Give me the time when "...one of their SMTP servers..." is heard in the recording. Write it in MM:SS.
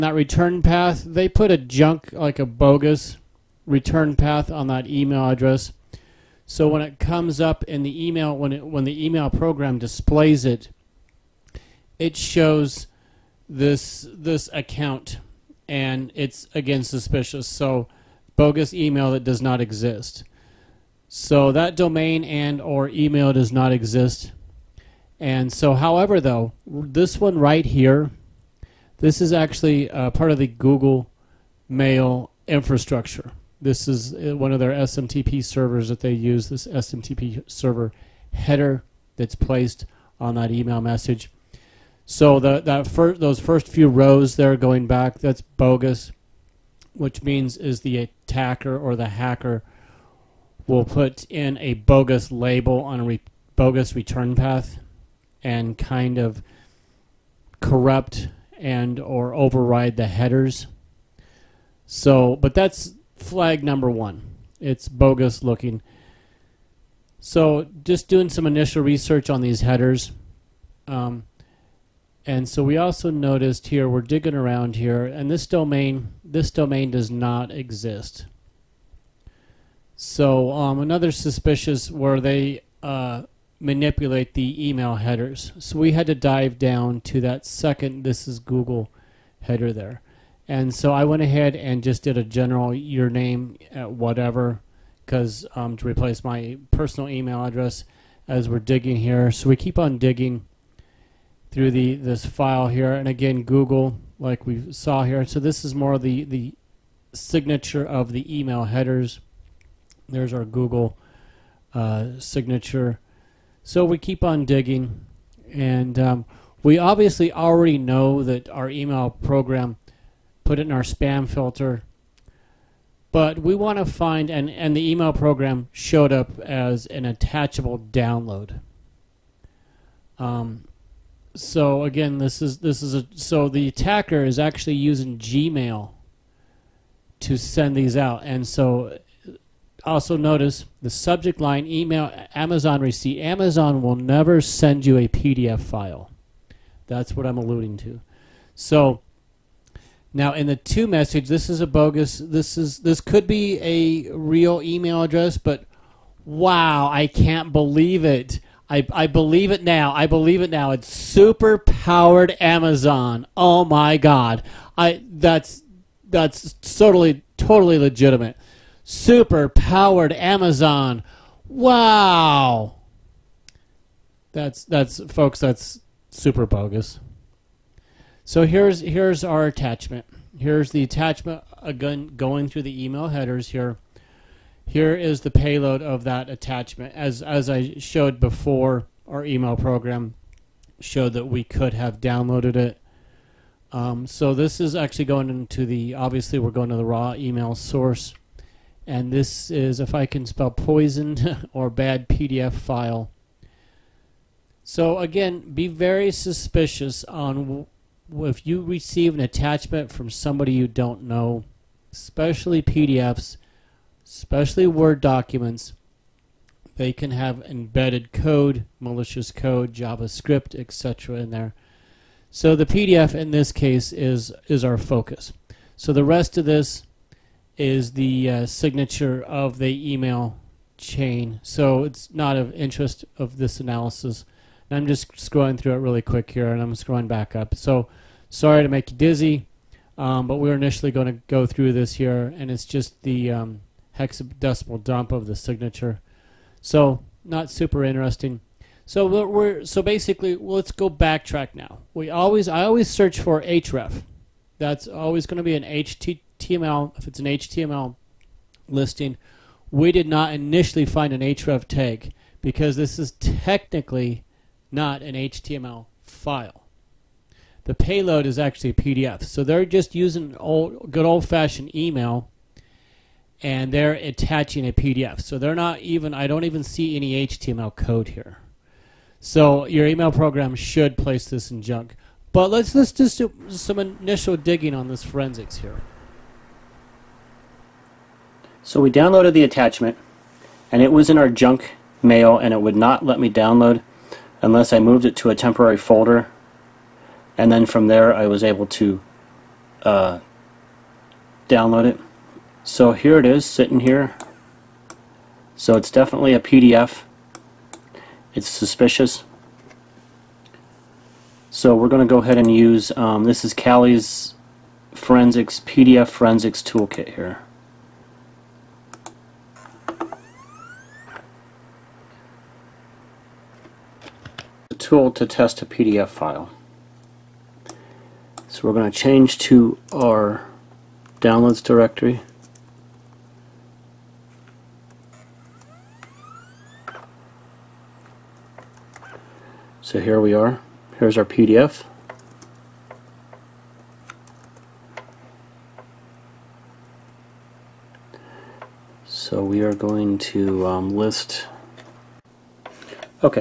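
00:34.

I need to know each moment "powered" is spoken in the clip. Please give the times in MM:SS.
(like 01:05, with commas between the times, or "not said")
02:41, 02:49.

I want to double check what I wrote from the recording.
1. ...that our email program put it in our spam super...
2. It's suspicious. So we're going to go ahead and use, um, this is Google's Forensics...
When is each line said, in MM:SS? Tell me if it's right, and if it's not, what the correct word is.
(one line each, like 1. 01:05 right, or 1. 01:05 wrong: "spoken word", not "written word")
1. 01:58 wrong: "filter", not "super"
2. 05:08 wrong: "Kali", not "Google".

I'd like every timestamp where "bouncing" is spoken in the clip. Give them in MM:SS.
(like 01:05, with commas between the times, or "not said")
not said.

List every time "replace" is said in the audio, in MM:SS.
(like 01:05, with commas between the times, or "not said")
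01:35.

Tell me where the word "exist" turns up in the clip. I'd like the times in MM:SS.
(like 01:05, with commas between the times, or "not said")
00:19, 00:23, 01:17.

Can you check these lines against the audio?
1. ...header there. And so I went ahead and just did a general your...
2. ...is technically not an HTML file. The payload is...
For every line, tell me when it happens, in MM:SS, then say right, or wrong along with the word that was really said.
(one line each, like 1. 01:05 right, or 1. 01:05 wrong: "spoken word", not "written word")
1. 01:29 right
2. 04:22 right.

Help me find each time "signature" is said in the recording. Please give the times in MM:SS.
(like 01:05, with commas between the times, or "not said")
01:47, 01:52, 03:48, 04:05.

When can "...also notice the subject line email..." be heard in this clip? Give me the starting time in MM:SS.
02:19.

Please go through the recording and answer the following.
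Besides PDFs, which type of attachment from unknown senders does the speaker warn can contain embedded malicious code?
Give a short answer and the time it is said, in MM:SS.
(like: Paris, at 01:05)
Word documents, at 03:34.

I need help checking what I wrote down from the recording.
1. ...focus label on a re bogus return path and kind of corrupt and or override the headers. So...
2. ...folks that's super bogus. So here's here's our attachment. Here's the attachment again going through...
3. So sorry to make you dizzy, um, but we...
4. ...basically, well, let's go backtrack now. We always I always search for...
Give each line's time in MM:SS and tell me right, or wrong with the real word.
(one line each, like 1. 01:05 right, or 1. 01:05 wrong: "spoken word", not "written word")
1. 00:51 wrong: "bogus", not "focus"
2. 02:55 right
3. 03:57 right
4. 04:09 right.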